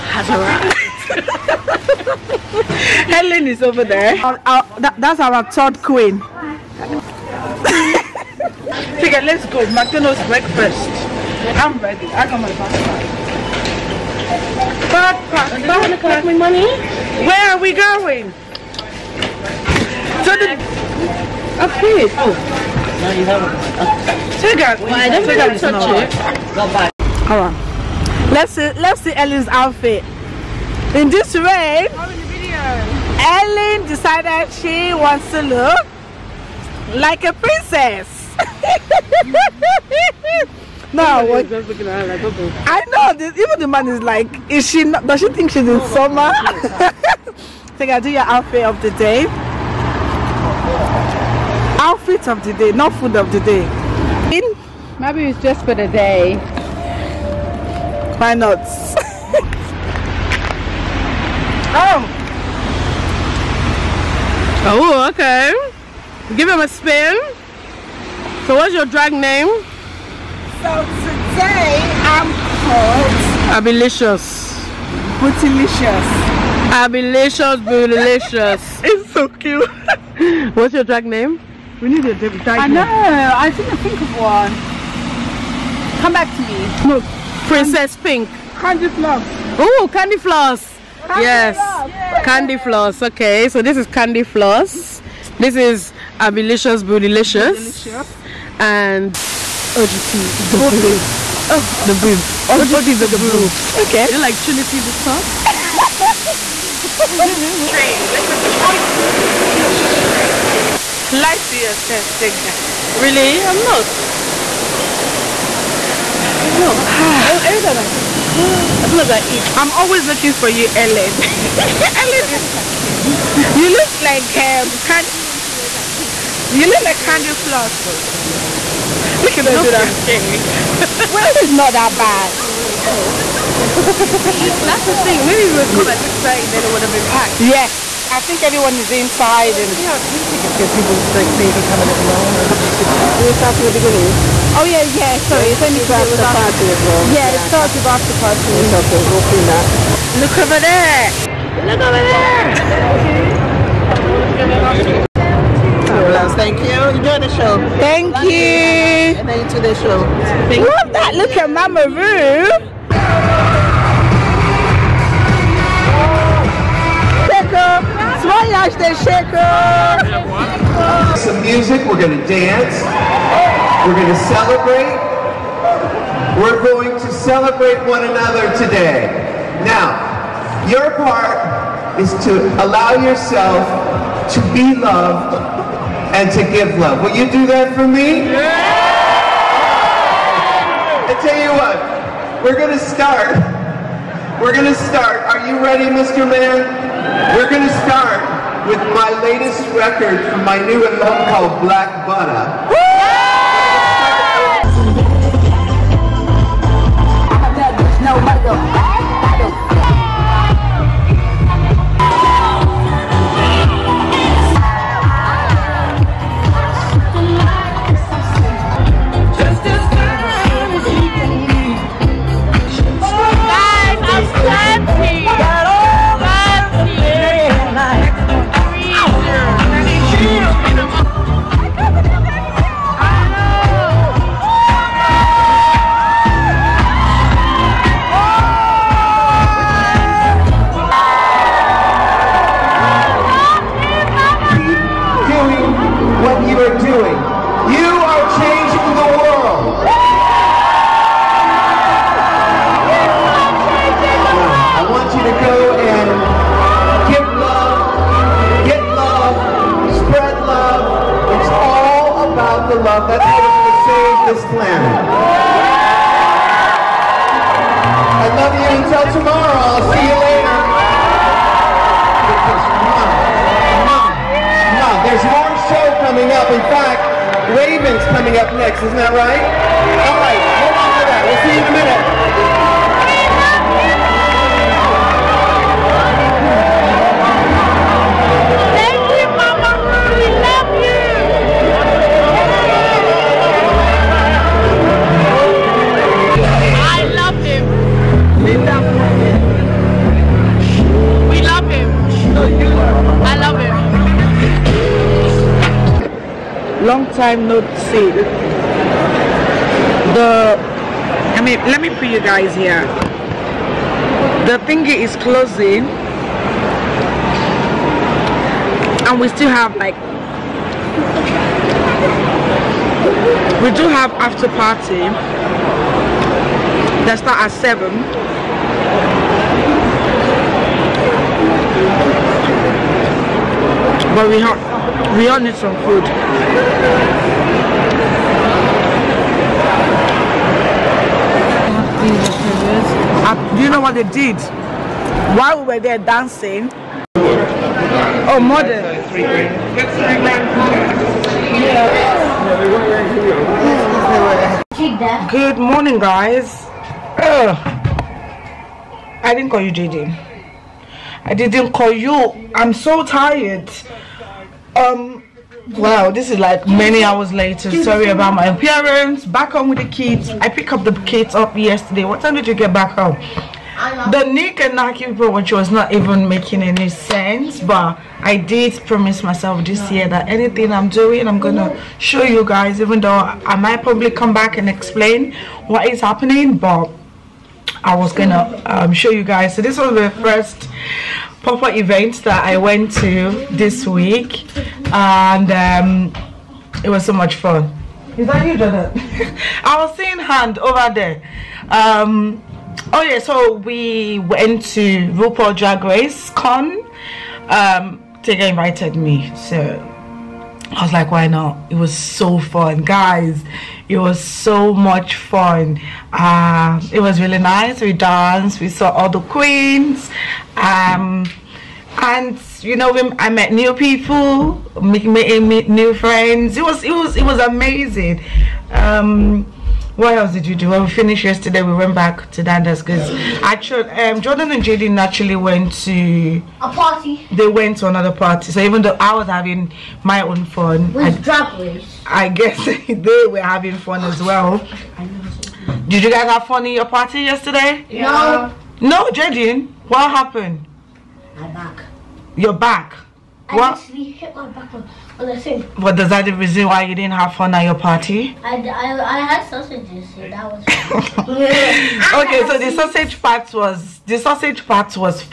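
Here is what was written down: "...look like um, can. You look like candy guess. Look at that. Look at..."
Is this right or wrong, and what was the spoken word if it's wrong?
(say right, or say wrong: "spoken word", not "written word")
wrong: "floss", not "guess".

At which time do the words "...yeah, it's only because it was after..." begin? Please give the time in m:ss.
2:25.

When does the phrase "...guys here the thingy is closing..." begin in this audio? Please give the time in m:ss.
5:12.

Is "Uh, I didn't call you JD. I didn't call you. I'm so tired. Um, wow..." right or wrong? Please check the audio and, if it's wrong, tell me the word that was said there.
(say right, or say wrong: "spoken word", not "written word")
right.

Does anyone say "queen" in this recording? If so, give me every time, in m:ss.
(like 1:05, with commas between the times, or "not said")
0:05, 6:59.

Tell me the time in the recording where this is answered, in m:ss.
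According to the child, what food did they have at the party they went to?
7:39.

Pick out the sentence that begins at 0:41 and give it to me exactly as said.
Just looking at her like, okay.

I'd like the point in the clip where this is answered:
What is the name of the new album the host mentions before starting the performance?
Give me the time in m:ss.
3:21.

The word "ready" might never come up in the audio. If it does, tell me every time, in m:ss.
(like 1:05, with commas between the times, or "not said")
0:11, 3:15.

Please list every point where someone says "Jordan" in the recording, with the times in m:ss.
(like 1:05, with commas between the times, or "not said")
6:38, 7:14.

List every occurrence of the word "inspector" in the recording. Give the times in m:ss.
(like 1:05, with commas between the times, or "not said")
not said.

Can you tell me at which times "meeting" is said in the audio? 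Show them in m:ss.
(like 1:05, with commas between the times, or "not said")
7:04.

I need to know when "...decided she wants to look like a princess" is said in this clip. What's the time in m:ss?
0:33.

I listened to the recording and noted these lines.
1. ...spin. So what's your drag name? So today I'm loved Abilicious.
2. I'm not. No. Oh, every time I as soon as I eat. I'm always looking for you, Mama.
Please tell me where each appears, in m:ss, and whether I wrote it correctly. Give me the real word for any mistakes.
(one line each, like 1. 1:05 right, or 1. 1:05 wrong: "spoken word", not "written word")
1. 1:06 wrong: "called", not "loved"
2. 1:53 wrong: "Ellen", not "Mama".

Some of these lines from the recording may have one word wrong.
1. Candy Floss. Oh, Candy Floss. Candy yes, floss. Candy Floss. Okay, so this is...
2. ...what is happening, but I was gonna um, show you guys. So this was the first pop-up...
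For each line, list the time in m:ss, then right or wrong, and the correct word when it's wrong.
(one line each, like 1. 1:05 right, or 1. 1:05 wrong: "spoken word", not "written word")
1. 1:28 right
2. 6:25 right.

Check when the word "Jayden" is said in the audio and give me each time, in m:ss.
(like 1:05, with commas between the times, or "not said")
7:14, 7:29.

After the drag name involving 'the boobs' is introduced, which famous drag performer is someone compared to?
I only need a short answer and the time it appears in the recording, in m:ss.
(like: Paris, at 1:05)
Trinity the Tuck, at 1:44.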